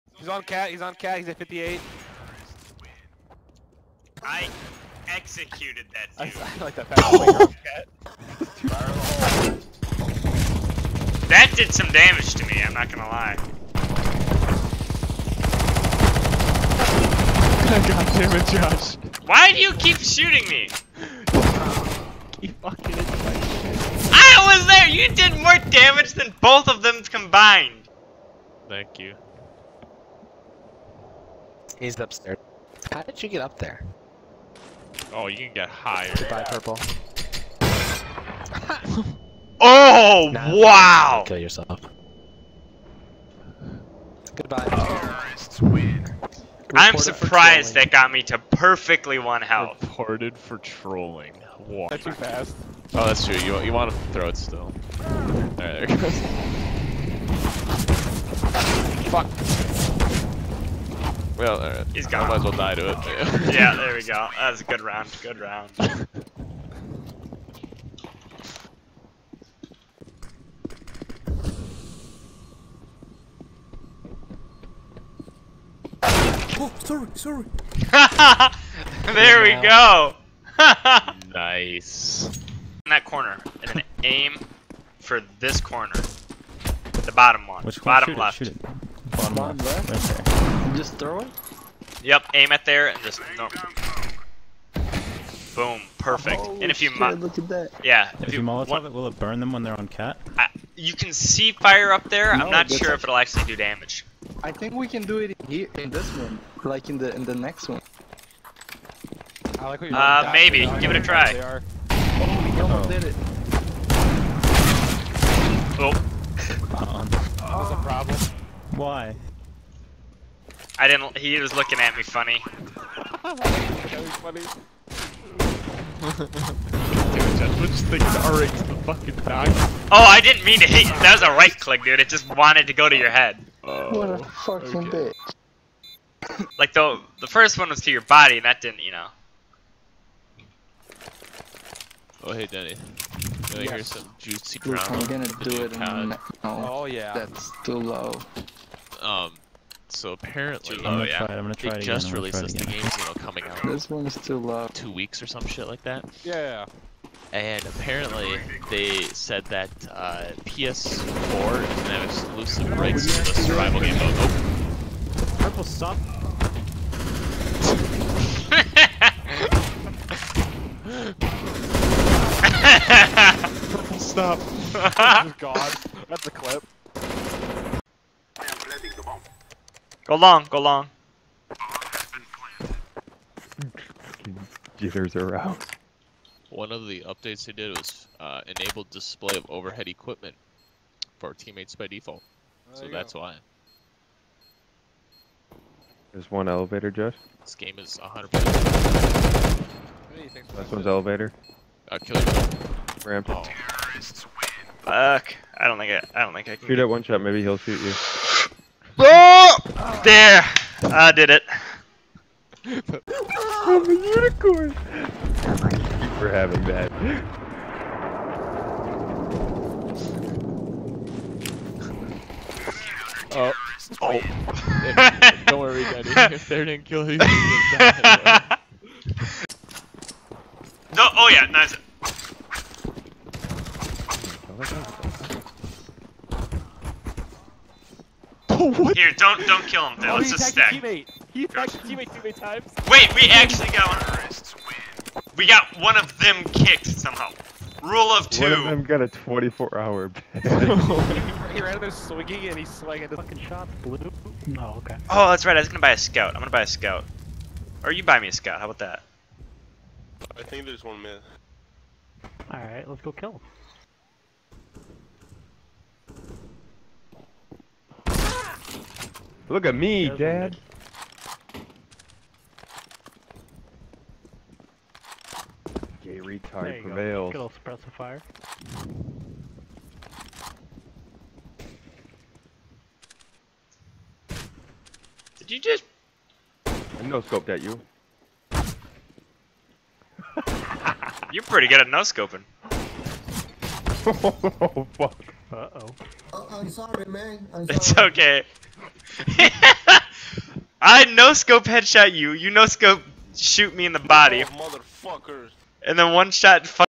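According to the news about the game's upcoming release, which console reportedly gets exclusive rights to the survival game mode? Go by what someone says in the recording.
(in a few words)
PS4.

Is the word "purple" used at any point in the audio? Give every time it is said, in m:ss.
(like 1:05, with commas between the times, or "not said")
0:36, 2:45, 2:53.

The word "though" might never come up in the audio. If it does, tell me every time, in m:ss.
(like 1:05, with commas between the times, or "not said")
2:16, 3:59.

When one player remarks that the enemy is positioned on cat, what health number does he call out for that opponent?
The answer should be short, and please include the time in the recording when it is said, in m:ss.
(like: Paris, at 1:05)
58, at 0:01.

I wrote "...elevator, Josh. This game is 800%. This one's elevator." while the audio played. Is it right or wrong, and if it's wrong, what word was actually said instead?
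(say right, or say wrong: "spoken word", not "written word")
wrong: "100", not "800".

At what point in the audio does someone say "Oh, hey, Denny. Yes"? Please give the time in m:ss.
2:22.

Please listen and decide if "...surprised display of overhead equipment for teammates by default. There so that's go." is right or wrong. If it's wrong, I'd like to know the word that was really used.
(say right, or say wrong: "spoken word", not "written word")
wrong: "enabled", not "surprised".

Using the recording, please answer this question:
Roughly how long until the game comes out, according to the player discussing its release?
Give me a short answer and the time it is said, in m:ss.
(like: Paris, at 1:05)
2 weeks, at 2:34.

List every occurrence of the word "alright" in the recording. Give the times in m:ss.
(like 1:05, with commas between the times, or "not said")
0:55, 1:01, 4:22.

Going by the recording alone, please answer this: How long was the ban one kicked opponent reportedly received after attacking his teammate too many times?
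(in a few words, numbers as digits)
24 hours.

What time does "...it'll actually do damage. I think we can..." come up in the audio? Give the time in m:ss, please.
1:43.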